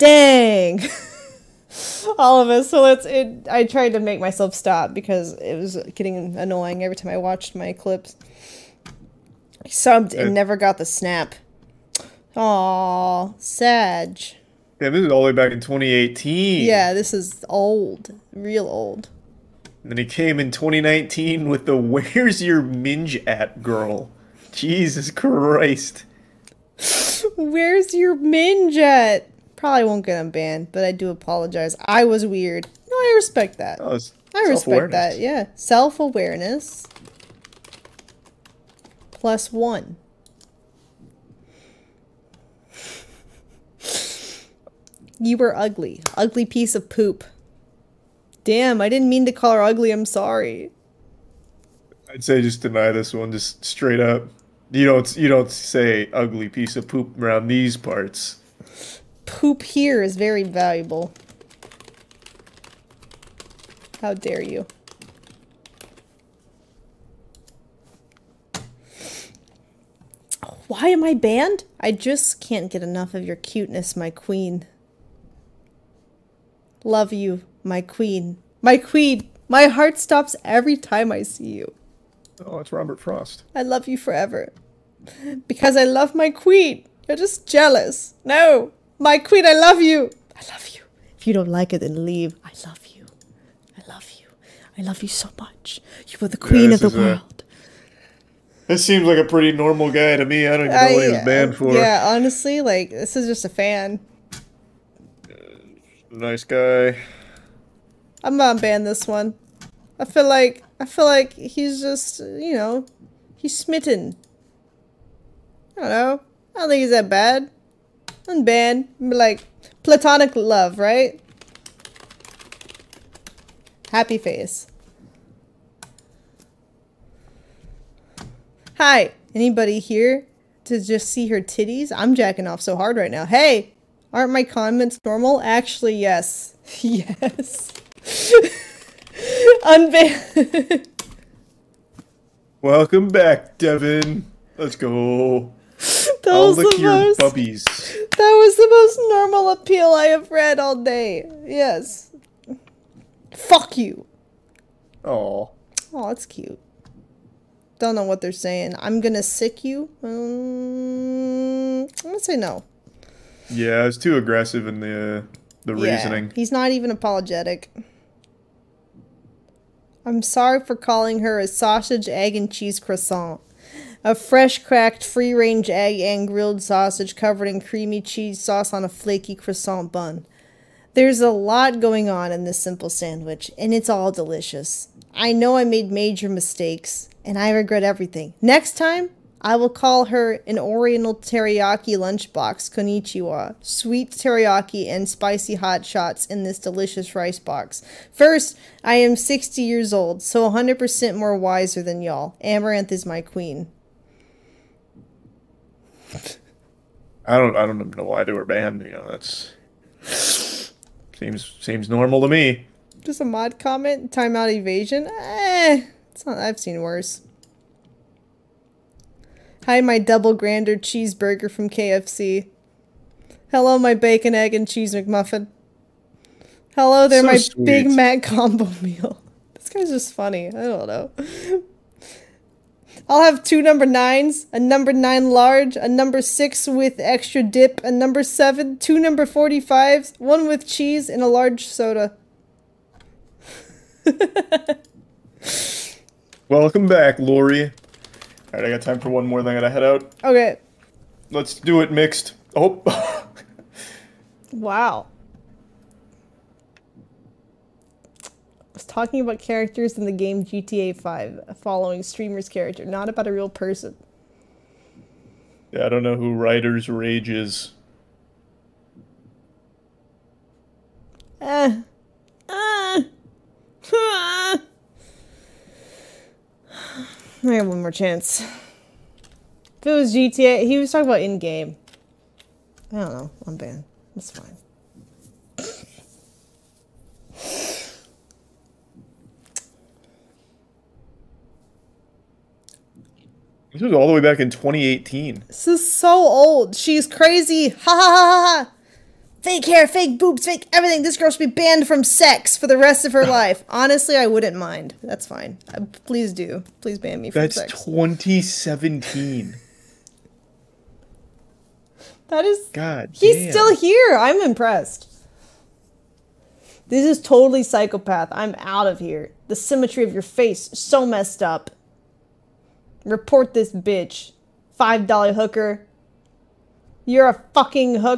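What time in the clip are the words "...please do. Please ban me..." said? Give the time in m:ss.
5:06.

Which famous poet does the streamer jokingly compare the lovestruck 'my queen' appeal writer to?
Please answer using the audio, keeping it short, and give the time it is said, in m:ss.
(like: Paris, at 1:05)
Robert Frost, at 1:22.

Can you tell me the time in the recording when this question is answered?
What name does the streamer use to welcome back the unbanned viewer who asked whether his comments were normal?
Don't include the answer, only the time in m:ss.
2:23.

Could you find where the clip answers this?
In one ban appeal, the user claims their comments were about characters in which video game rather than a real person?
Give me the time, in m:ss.
4:20.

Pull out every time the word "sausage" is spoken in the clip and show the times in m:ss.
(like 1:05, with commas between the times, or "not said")
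2:51, 2:56.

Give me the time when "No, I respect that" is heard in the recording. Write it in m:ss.
0:32.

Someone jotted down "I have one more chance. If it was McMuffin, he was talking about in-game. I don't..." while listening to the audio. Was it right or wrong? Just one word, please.
wrong.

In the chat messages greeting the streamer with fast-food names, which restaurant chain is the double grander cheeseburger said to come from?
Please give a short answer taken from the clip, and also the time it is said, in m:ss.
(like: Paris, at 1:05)
KFC, at 3:41.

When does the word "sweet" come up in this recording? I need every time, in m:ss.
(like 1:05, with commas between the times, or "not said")
3:13, 3:47.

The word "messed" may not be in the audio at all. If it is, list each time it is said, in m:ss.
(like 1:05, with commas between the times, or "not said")
5:21.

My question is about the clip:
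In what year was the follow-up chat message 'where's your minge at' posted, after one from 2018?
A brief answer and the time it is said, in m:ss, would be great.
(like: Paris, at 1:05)
2019, at 0:20.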